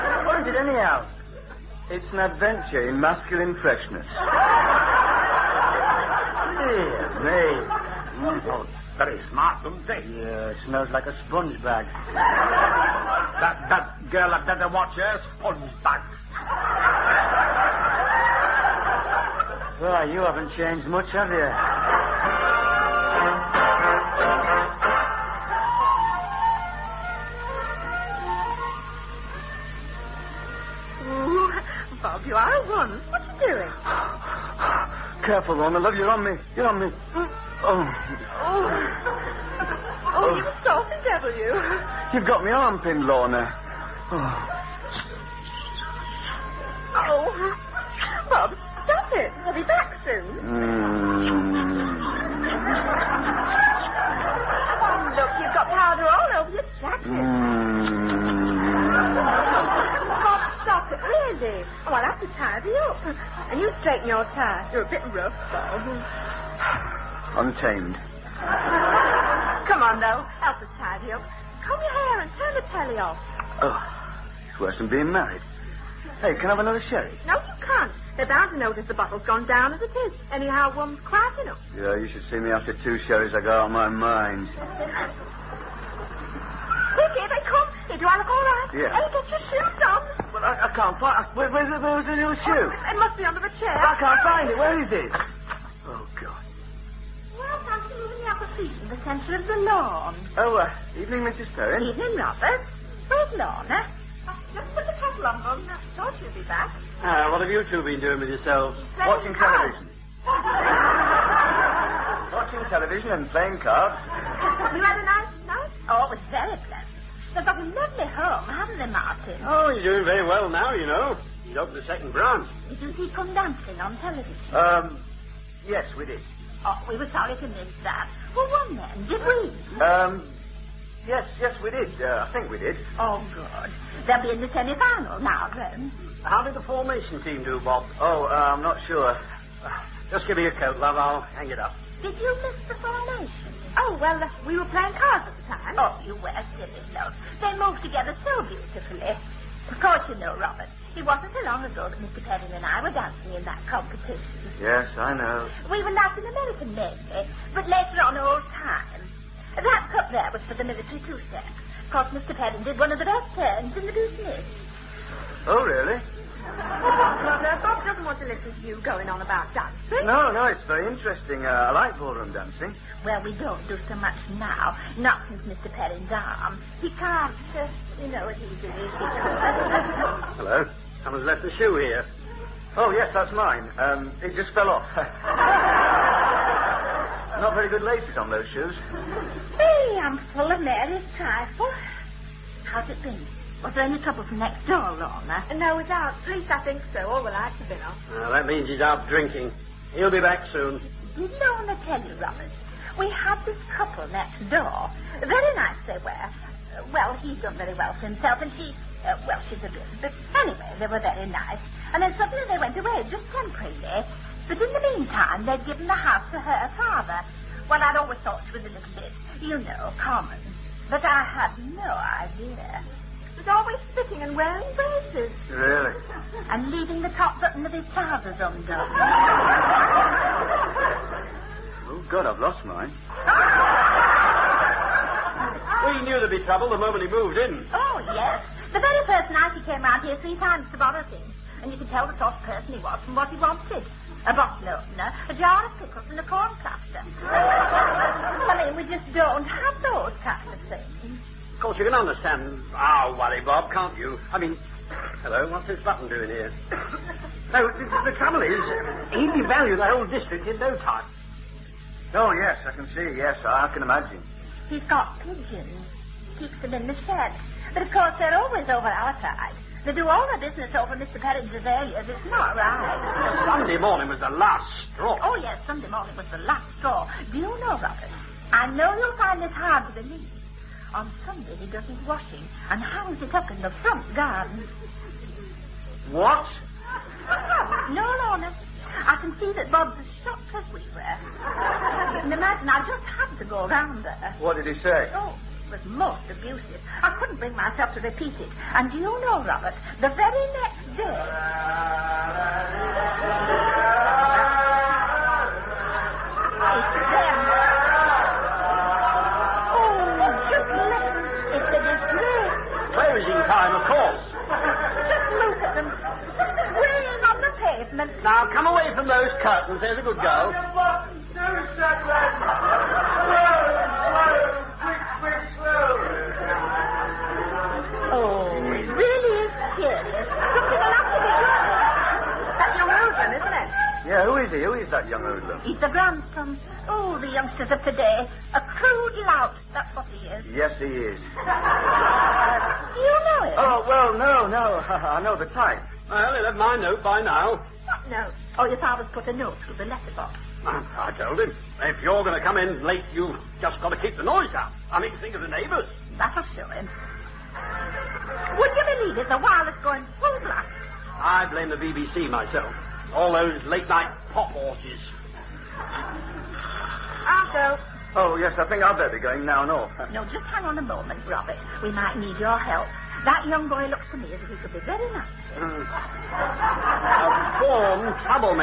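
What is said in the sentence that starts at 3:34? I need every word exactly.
But in the meantime, they'd given the house to her father.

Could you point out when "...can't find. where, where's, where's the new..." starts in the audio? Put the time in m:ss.
1:30.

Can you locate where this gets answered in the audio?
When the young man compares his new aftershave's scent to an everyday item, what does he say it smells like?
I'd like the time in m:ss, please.
0:11.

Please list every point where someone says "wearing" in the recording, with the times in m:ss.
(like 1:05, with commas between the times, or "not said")
3:44.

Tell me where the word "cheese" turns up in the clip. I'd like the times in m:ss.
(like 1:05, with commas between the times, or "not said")
not said.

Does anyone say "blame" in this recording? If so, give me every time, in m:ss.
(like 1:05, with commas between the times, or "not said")
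6:01.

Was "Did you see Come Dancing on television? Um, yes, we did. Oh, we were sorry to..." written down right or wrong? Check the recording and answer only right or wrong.
right.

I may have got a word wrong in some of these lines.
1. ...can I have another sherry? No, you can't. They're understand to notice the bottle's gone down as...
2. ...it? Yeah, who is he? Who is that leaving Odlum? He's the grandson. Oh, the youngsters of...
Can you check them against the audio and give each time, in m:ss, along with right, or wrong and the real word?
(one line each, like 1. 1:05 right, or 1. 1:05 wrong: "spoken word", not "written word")
1. 1:16 wrong: "bound", not "understand"
2. 5:33 wrong: "young", not "leaving".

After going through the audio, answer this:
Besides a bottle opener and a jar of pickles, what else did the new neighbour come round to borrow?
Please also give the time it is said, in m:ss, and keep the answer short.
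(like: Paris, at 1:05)
a corn cluster, at 4:06.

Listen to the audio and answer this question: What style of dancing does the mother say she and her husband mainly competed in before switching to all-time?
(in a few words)
Latin American.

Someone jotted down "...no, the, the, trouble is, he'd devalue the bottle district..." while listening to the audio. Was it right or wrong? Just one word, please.
wrong.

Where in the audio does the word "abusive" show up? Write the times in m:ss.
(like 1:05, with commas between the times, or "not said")
4:56.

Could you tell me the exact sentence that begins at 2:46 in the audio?
Bob doesn't want to listen to you going on about dancing.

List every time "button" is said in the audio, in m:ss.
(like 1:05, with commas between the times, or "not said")
3:47, 4:15.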